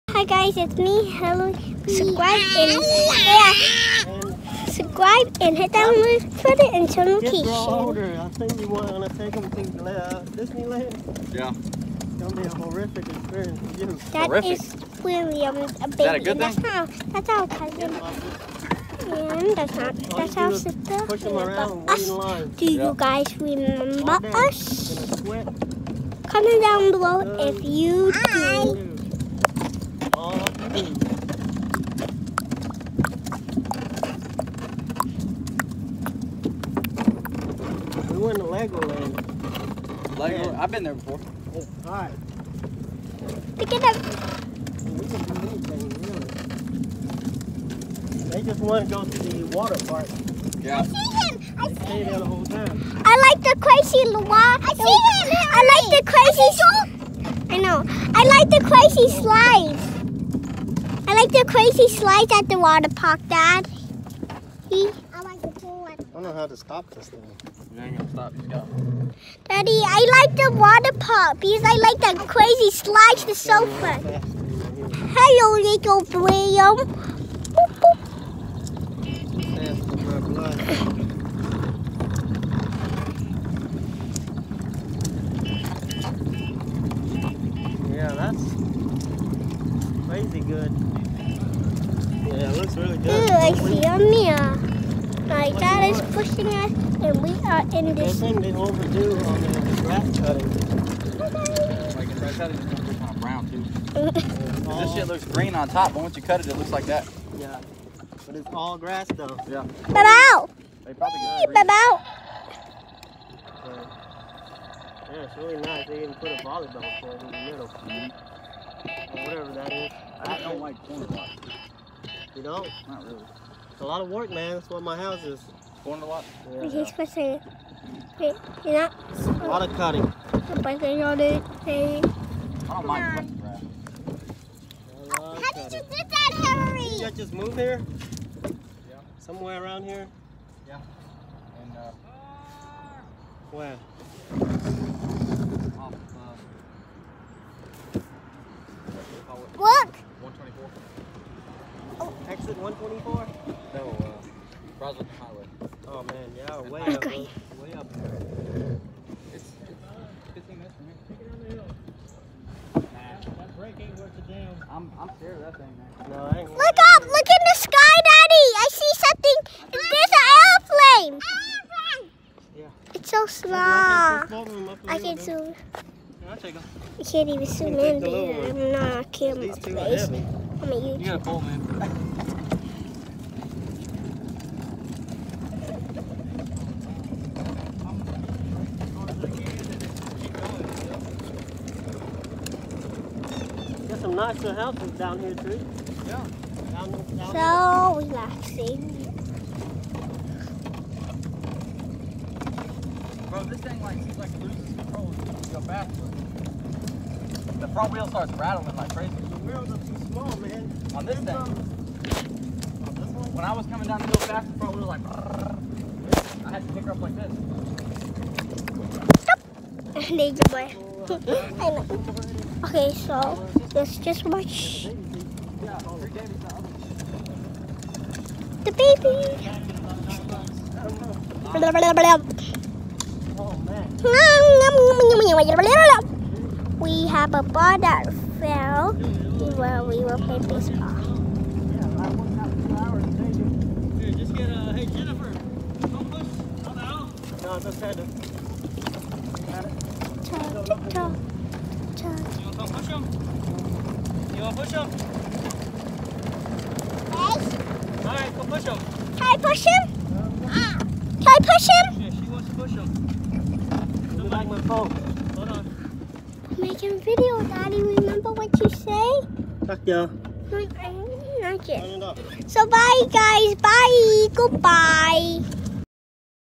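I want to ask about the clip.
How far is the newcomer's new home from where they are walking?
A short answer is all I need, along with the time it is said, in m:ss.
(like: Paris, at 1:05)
15 minutes, at 2:40.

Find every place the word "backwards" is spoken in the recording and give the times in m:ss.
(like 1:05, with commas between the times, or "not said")
3:25.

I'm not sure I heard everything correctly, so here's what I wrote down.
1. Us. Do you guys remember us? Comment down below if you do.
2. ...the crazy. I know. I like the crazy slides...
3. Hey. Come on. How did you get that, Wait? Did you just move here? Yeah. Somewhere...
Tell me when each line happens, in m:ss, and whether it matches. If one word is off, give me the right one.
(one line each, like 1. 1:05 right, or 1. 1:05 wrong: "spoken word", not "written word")
1. 0:21 right
2. 0:55 right
3. 2:11 wrong: "Henry", not "Wait".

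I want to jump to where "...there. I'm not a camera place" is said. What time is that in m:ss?
2:57.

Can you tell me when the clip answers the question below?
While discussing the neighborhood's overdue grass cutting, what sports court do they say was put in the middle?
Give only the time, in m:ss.
1:56.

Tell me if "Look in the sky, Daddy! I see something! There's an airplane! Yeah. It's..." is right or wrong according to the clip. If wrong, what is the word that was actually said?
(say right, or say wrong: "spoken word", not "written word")
right.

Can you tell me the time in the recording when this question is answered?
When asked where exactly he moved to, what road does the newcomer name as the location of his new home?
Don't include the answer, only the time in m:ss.
2:34.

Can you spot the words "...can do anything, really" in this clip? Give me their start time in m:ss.
0:45.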